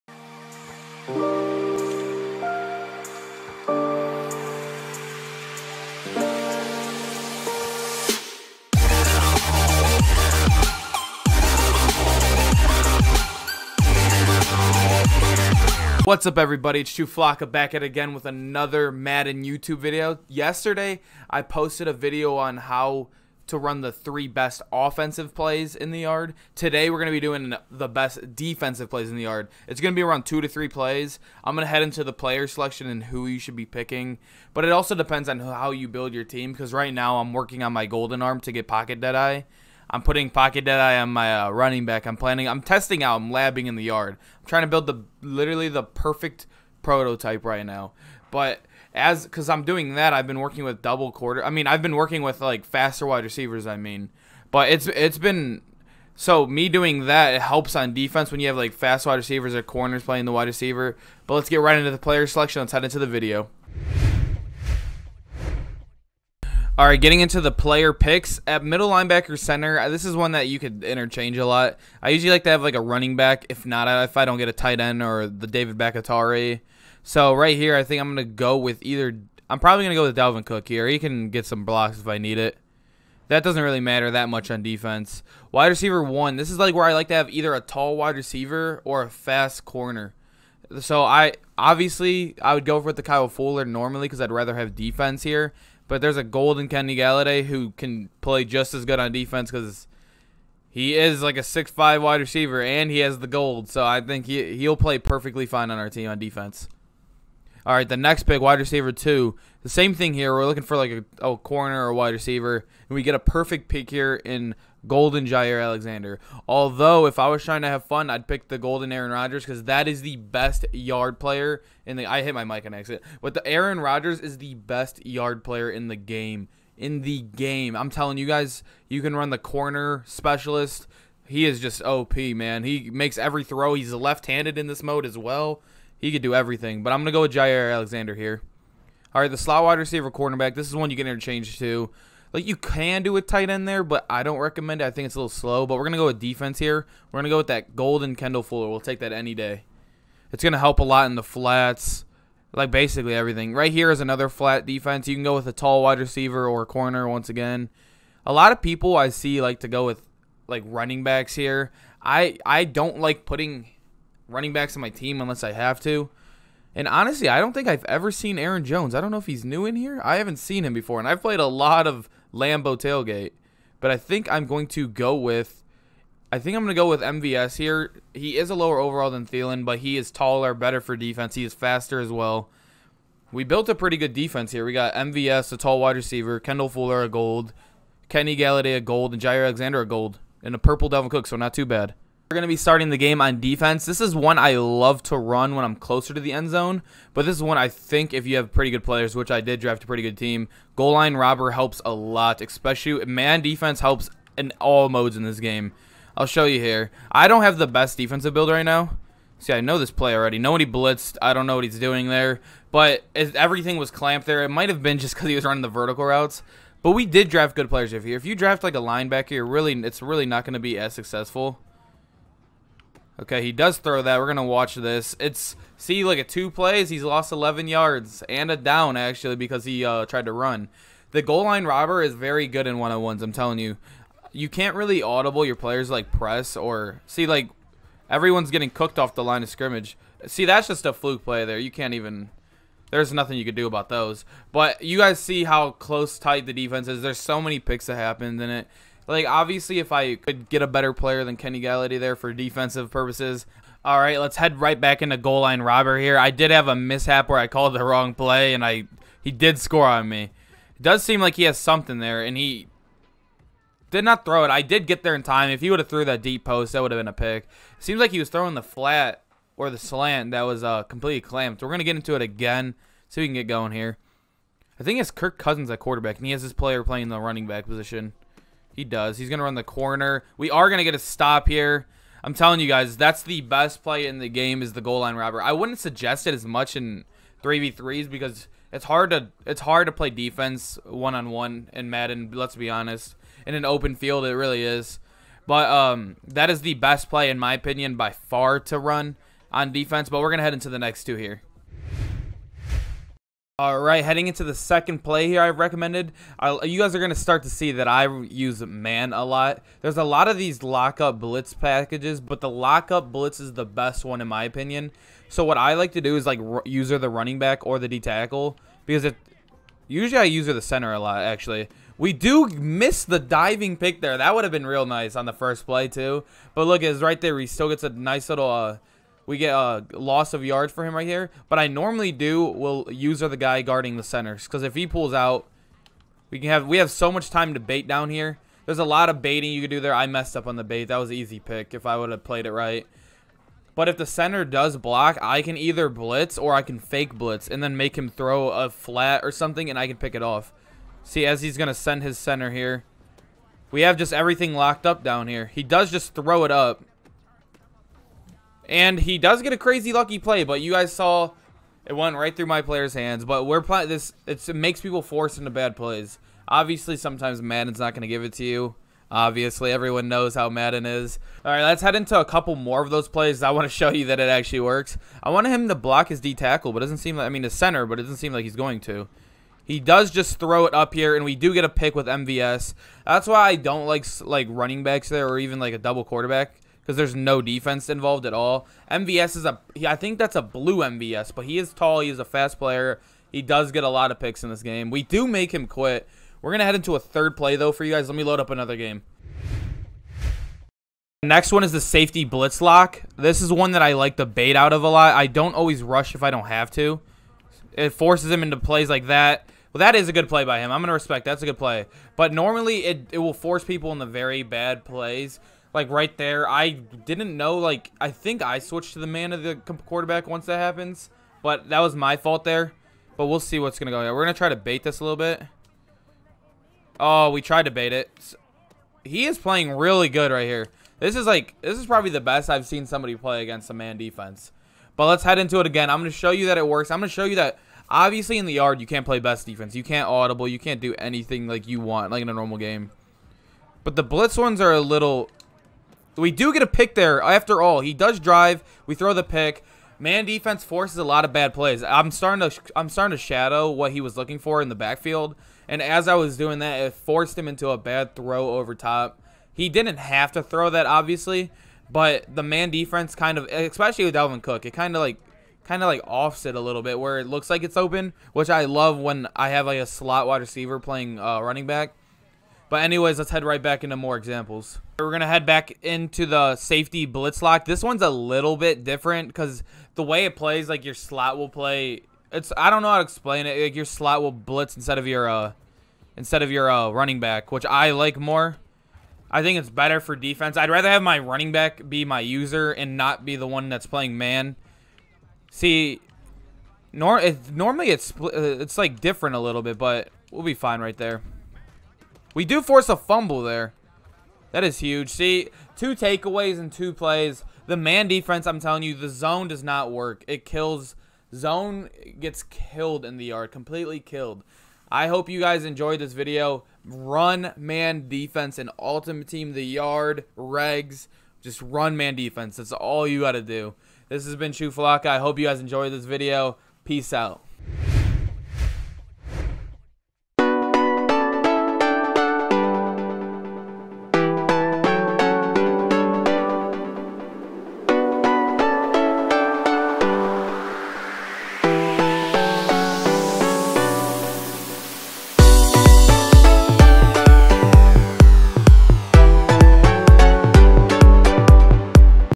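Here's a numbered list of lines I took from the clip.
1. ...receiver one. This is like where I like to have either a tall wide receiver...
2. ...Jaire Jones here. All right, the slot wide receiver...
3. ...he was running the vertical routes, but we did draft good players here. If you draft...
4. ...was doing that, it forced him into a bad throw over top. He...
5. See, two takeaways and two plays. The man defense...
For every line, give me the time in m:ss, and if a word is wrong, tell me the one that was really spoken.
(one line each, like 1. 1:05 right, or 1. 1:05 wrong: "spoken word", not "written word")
1. 1:25 right
2. 2:17 wrong: "Alexander", not "Jones"
3. 3:35 right
4. 7:36 right
5. 8:25 right.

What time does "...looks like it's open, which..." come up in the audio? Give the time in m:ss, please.
7:47.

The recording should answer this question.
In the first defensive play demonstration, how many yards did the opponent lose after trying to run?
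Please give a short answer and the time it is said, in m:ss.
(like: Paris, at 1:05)
11, at 3:47.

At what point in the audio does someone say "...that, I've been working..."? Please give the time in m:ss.
0:49.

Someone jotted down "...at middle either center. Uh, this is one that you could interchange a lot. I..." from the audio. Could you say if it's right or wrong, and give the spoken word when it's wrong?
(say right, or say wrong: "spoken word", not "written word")
wrong: "linebacker", not "either".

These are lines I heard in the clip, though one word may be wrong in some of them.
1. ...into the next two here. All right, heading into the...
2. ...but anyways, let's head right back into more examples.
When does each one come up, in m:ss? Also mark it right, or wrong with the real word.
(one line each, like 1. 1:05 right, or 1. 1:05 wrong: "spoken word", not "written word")
1. 5:00 right
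2. 7:52 right.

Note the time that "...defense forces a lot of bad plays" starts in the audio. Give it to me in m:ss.
7:30.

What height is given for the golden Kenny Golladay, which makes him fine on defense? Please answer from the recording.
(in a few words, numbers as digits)
6'5".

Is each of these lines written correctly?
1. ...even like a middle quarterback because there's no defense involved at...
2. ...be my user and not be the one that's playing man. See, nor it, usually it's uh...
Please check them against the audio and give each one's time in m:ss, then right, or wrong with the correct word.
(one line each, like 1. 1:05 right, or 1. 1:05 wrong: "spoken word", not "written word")
1. 6:25 wrong: "double", not "middle"
2. 8:11 wrong: "normally", not "usually".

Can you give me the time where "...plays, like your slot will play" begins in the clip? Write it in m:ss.
8:00.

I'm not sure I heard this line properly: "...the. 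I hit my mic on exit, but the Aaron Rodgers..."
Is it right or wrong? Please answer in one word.
right.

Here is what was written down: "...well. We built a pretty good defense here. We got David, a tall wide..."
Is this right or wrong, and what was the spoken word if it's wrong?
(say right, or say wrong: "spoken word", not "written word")
wrong: "MVS", not "David".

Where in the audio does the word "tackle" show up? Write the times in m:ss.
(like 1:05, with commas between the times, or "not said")
5:17, 6:16.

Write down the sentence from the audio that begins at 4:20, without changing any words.
It does seem like he has something there, and he did not throw it.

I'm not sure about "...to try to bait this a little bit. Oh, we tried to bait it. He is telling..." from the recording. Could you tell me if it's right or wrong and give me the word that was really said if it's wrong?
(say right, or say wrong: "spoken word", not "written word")
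wrong: "playing", not "telling".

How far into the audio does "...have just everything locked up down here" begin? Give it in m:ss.
5:53.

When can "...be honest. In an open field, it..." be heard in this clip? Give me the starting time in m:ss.
4:52.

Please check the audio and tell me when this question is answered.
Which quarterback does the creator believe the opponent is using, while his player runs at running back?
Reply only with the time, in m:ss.
4:35.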